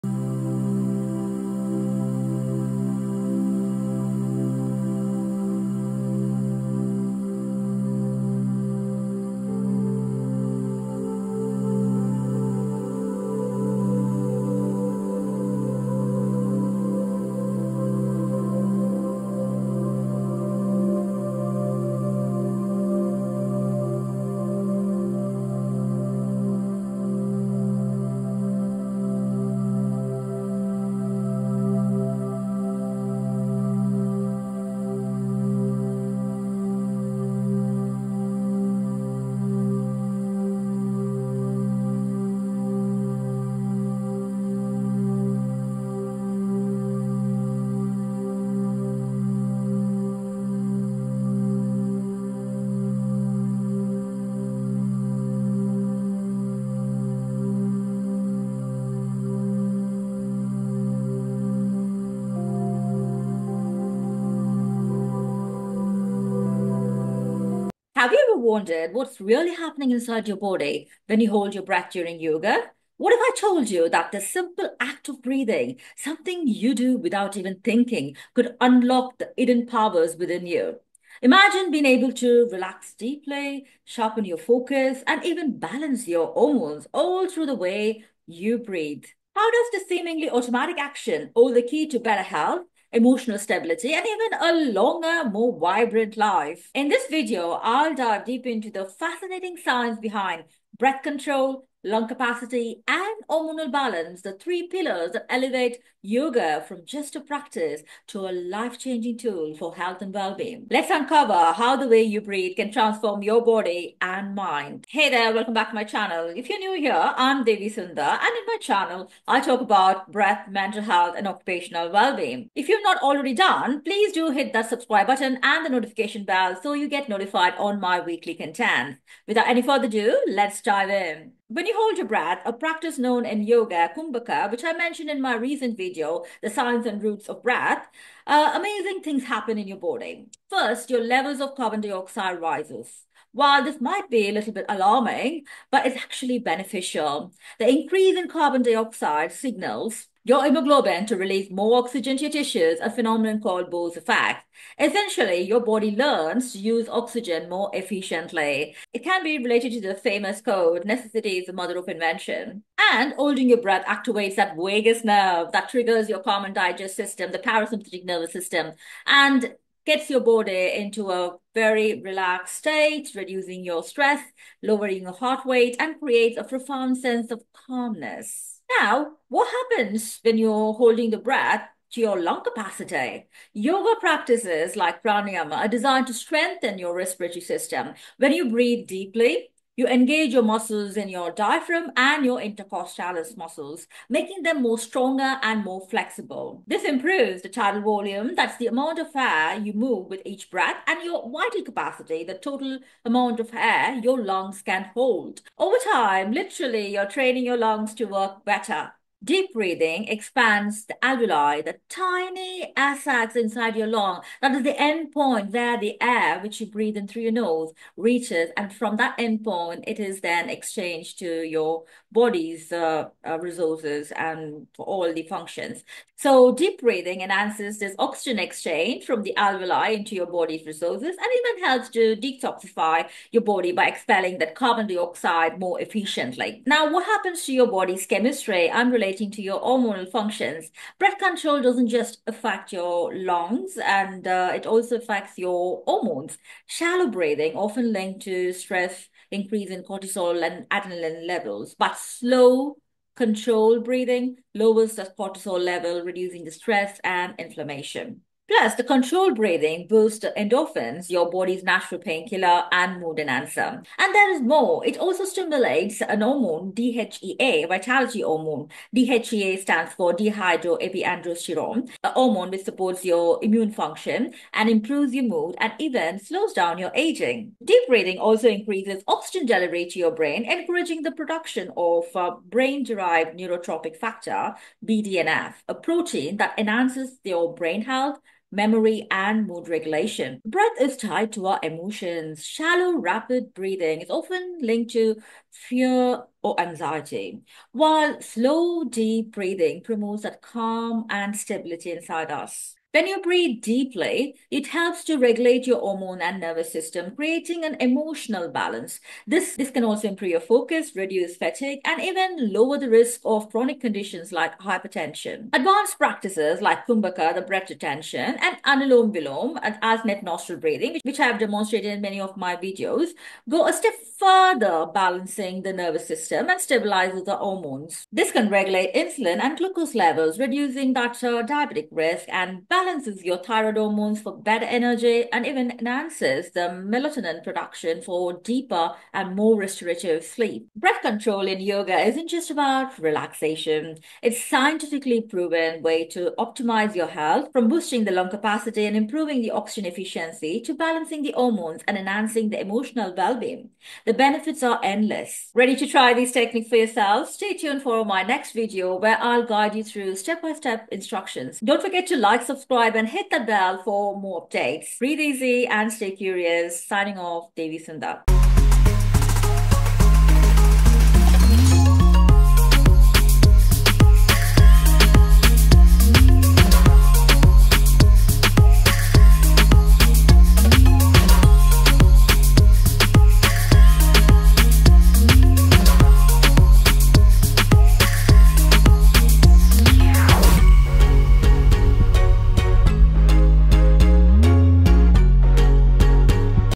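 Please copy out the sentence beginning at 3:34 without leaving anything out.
That is the end point where the air, which you breathe in through your nose, reaches.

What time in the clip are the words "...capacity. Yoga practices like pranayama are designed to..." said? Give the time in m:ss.
3:02.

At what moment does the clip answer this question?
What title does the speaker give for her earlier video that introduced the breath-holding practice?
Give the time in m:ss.
2:16.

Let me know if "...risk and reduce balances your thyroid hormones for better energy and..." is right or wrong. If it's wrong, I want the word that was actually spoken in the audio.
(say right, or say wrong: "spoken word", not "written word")
wrong: "balance", not "reduce".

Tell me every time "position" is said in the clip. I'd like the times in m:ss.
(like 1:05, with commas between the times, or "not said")
not said.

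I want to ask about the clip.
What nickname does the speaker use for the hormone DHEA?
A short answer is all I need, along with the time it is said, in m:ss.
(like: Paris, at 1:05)
vitality hormone, at 4:27.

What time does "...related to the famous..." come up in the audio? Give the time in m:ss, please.
2:39.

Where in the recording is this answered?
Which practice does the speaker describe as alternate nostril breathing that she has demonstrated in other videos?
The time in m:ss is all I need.
5:18.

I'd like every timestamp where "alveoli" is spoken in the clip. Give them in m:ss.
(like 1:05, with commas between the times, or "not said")
3:31, 3:49.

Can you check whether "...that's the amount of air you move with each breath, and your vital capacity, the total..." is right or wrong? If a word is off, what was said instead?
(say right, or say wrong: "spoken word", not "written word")
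right.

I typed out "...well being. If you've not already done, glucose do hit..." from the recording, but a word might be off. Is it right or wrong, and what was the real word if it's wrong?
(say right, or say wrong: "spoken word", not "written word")
wrong: "please", not "glucose".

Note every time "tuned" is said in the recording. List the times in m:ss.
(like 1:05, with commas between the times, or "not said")
5:57.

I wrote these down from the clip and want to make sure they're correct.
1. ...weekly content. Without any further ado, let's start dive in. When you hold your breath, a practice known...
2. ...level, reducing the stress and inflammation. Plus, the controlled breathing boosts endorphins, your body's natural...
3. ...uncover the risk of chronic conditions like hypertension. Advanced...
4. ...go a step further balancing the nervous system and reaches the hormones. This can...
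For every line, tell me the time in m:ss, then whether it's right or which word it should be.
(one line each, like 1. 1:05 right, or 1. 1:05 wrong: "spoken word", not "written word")
1. 2:07 right
2. 4:15 right
3. 5:12 wrong: "lower", not "uncover"
4. 5:23 wrong: "stabilizes", not "reaches".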